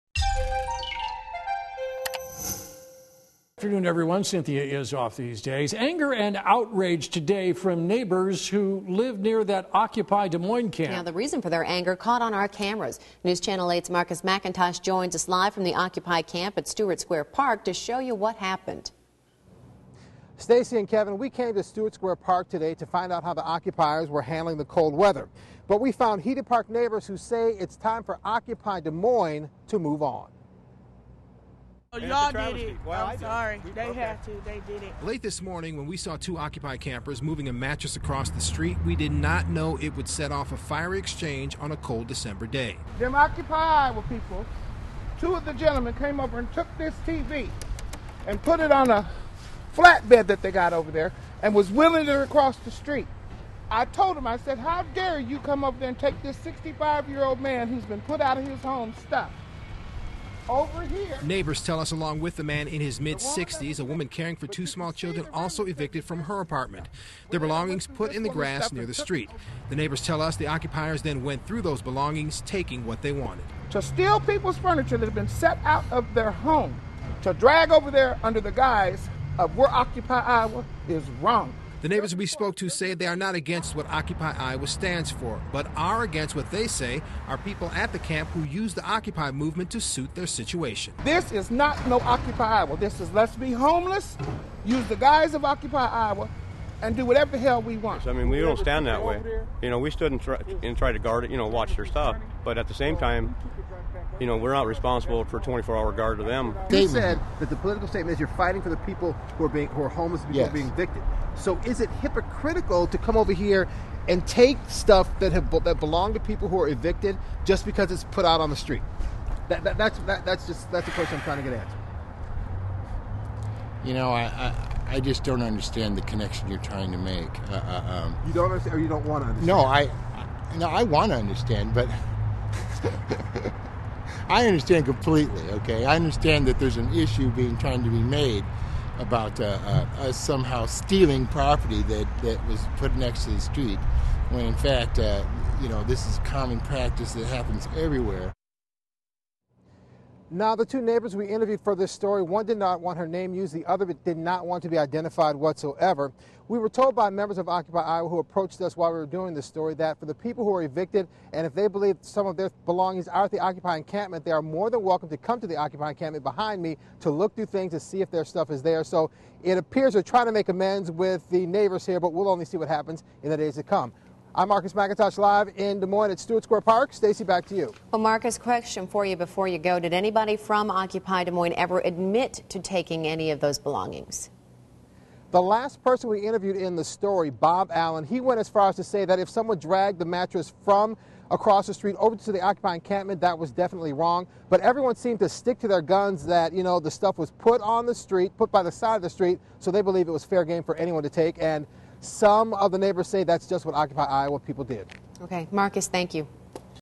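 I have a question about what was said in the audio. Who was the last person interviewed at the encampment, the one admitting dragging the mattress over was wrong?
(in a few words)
Bob Allen.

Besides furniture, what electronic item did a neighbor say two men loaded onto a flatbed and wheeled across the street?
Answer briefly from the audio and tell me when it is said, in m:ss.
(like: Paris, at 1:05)
TV, at 0:47.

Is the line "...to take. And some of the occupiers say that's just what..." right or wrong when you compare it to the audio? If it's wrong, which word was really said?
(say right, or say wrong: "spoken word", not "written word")
wrong: "neighbors", not "occupiers".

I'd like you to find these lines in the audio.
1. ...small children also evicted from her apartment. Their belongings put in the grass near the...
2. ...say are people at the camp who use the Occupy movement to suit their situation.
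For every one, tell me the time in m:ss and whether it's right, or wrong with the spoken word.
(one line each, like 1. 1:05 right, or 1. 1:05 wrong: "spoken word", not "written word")
1. 1:04 right
2. 1:26 right.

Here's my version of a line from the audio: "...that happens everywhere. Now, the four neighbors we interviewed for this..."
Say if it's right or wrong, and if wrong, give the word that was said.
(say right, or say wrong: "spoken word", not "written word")
wrong: "two", not "four".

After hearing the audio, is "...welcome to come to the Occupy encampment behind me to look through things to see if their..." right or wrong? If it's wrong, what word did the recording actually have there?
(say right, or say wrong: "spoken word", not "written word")
right.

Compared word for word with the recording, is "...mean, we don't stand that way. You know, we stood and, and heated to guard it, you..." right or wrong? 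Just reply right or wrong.
wrong.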